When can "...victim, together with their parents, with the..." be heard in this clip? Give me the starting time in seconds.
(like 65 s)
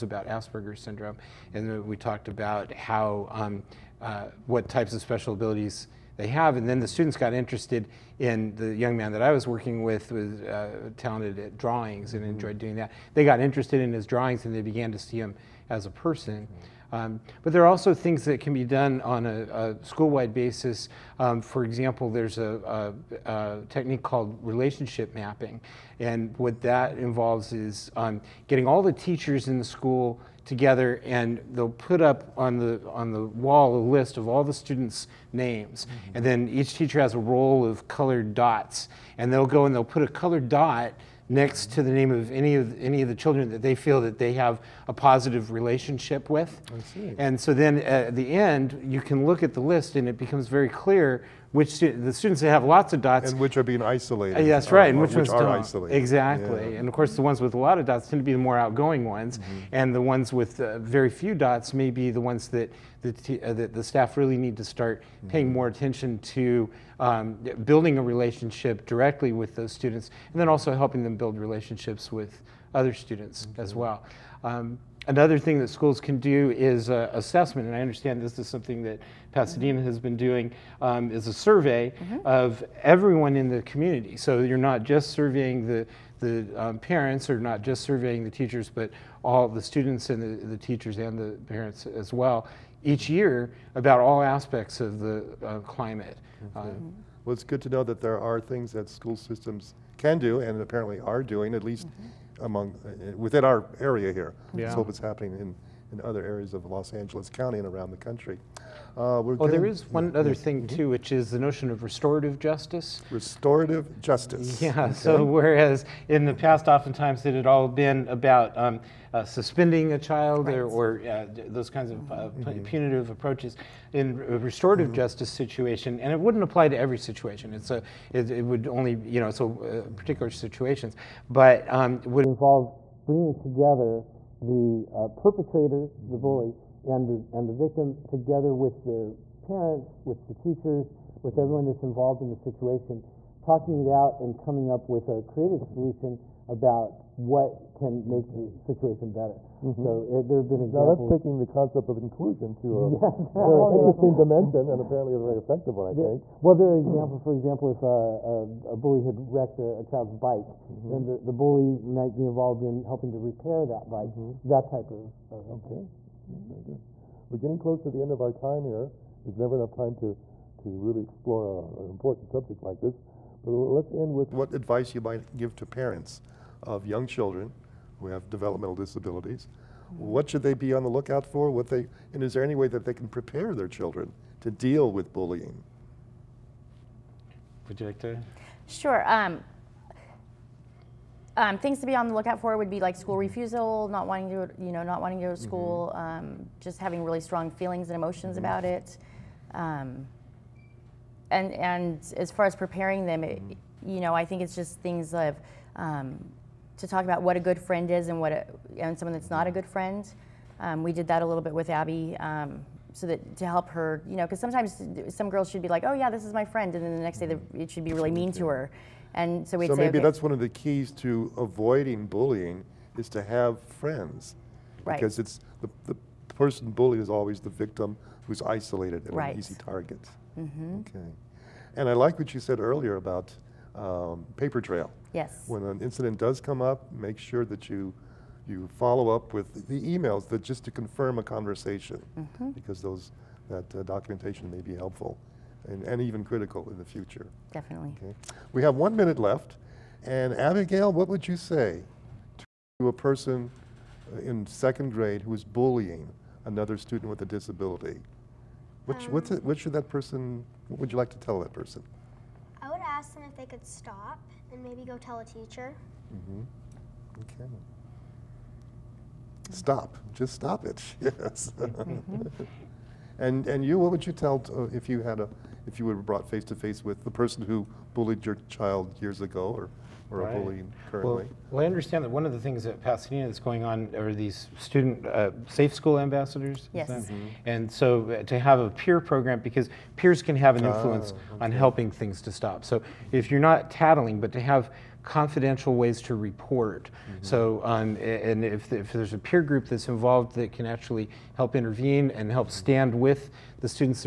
137 s.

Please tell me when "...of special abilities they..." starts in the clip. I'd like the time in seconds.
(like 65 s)
4 s.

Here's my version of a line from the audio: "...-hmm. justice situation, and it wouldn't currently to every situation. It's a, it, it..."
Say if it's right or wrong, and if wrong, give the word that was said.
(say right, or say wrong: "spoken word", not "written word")
wrong: "apply", not "currently".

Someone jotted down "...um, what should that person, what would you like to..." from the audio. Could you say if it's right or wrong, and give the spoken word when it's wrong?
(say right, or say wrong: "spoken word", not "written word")
right.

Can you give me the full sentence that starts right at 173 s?
But let's end with what advice you might give to parents of young children who have developmental disabilities.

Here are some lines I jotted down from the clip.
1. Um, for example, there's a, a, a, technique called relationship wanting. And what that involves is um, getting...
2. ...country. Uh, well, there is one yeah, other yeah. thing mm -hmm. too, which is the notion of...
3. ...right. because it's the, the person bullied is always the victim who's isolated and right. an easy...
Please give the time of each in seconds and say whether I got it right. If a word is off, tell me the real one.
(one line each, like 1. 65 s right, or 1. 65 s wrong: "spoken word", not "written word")
1. 21 s wrong: "mapping", not "wanting"
2. 107 s right
3. 224 s right.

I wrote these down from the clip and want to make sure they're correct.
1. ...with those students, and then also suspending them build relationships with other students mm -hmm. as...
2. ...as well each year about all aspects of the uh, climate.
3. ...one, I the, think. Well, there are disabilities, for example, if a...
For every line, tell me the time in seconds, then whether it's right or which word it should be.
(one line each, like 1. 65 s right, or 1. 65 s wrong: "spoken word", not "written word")
1. 69 s wrong: "helping", not "suspending"
2. 91 s right
3. 155 s wrong: "examples", not "disabilities".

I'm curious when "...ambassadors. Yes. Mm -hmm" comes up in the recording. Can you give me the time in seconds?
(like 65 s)
285 s.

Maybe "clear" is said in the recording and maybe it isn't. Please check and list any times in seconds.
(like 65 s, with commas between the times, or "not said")
50 s.